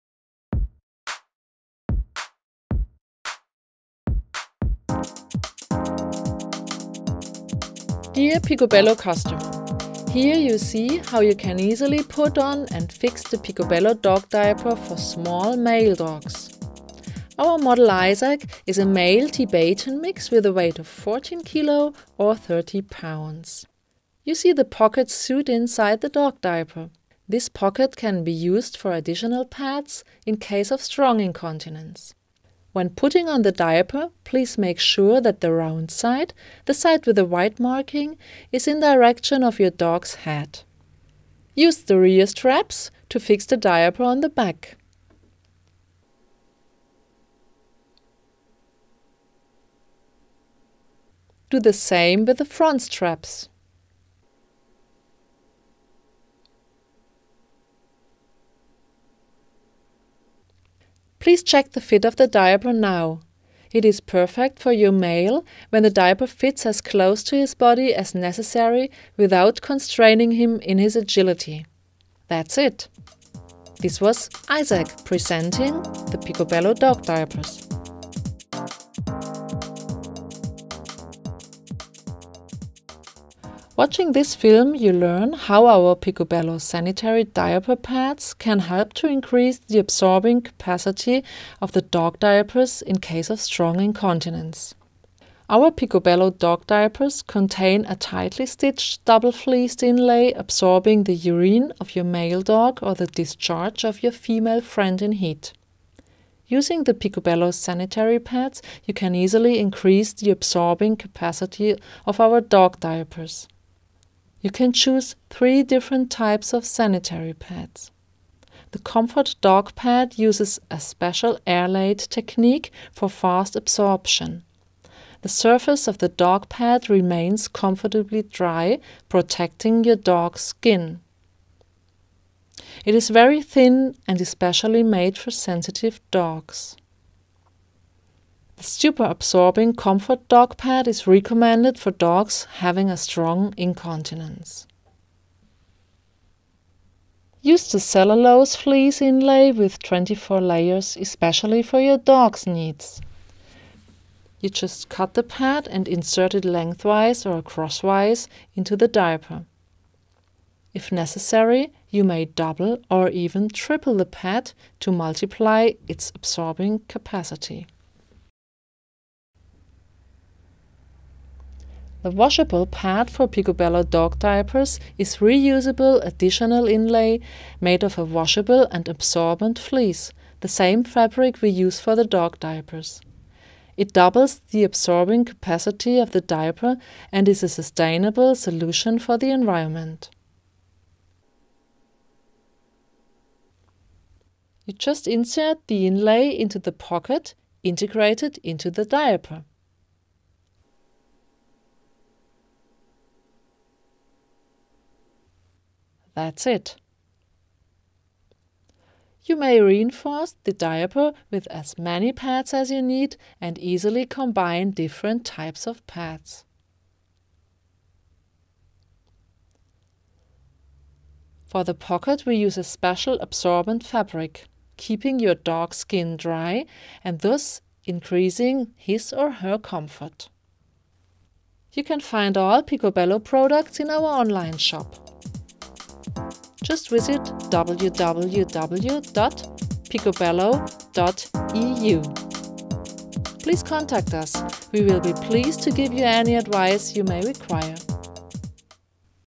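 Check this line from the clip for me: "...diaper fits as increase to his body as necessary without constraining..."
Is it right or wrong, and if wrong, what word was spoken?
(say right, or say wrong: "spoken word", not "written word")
wrong: "close", not "increase".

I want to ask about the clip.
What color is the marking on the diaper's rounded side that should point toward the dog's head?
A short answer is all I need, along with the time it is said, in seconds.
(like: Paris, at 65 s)
White, at 37 s.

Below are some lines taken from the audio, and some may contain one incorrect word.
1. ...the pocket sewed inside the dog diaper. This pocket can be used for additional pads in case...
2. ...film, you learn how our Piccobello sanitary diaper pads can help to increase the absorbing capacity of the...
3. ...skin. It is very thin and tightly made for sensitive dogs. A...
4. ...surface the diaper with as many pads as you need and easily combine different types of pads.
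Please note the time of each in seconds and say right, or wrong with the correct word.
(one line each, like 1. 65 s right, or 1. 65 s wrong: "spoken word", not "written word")
1. 24 s right
2. 84 s right
3. 130 s wrong: "especially", not "tightly"
4. 209 s wrong: "reinforce", not "surface".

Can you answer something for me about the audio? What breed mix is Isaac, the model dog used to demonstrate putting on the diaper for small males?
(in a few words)
Tibetan mix.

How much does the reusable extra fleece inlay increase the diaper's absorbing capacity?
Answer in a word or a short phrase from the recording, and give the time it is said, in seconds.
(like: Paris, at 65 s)
Doubles, at 183 s.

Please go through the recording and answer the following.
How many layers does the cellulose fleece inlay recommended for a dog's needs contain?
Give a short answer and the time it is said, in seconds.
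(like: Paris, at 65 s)
24, at 149 s.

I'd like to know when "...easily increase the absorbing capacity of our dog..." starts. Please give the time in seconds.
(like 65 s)
109 s.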